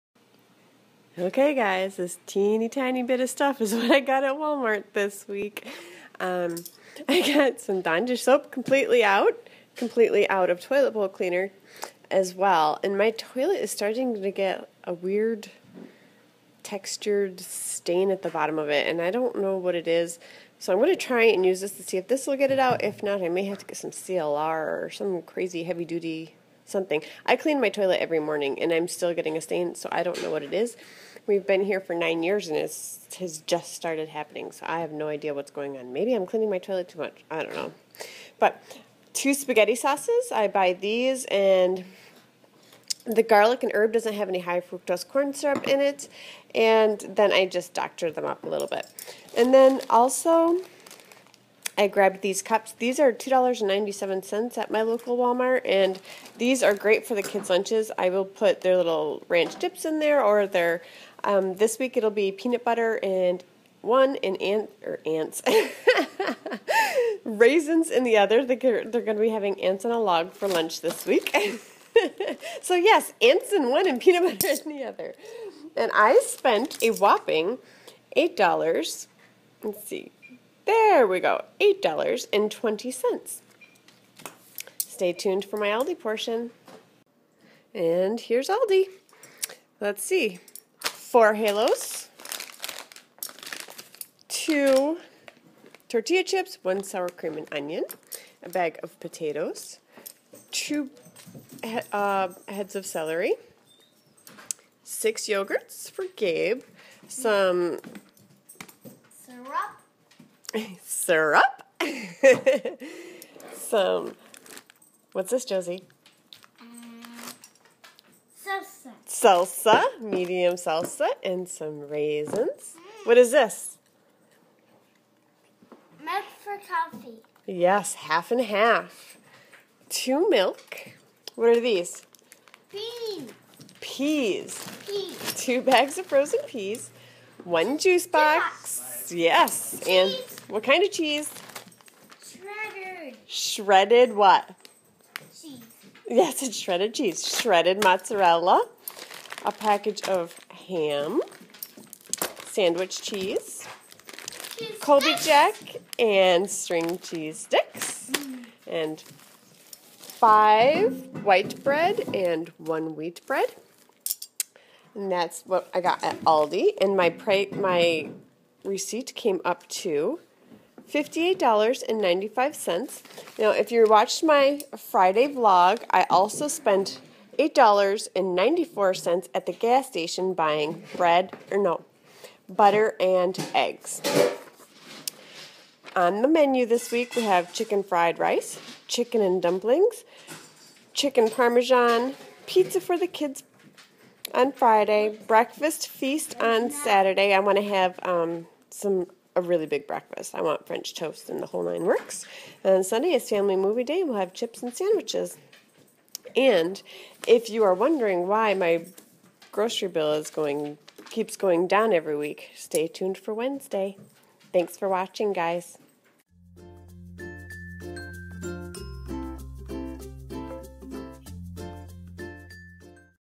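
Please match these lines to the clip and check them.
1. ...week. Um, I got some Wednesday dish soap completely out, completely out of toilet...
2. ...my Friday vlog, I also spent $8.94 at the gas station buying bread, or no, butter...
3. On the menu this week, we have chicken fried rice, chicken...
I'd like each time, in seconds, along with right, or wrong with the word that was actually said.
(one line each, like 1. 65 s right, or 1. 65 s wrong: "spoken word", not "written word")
1. 5 s wrong: "Dawn", not "Wednesday"
2. 174 s right
3. 185 s right.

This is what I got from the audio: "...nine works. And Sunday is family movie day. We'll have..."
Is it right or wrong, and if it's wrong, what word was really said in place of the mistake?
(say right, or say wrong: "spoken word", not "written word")
right.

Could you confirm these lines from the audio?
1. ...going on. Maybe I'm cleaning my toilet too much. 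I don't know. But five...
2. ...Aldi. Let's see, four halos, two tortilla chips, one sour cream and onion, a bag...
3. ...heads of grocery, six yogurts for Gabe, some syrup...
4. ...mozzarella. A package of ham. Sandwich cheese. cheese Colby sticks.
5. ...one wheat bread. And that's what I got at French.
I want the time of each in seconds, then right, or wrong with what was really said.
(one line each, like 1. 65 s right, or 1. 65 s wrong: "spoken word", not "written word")
1. 35 s wrong: "two", not "five"
2. 88 s right
3. 102 s wrong: "celery", not "grocery"
4. 147 s right
5. 162 s wrong: "Aldi", not "French".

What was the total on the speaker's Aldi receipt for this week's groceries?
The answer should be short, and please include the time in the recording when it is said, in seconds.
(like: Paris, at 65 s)
$58.95, at 170 s.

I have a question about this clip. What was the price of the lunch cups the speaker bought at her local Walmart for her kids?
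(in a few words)
$2.97.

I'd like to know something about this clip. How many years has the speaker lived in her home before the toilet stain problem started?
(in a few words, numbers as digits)
9.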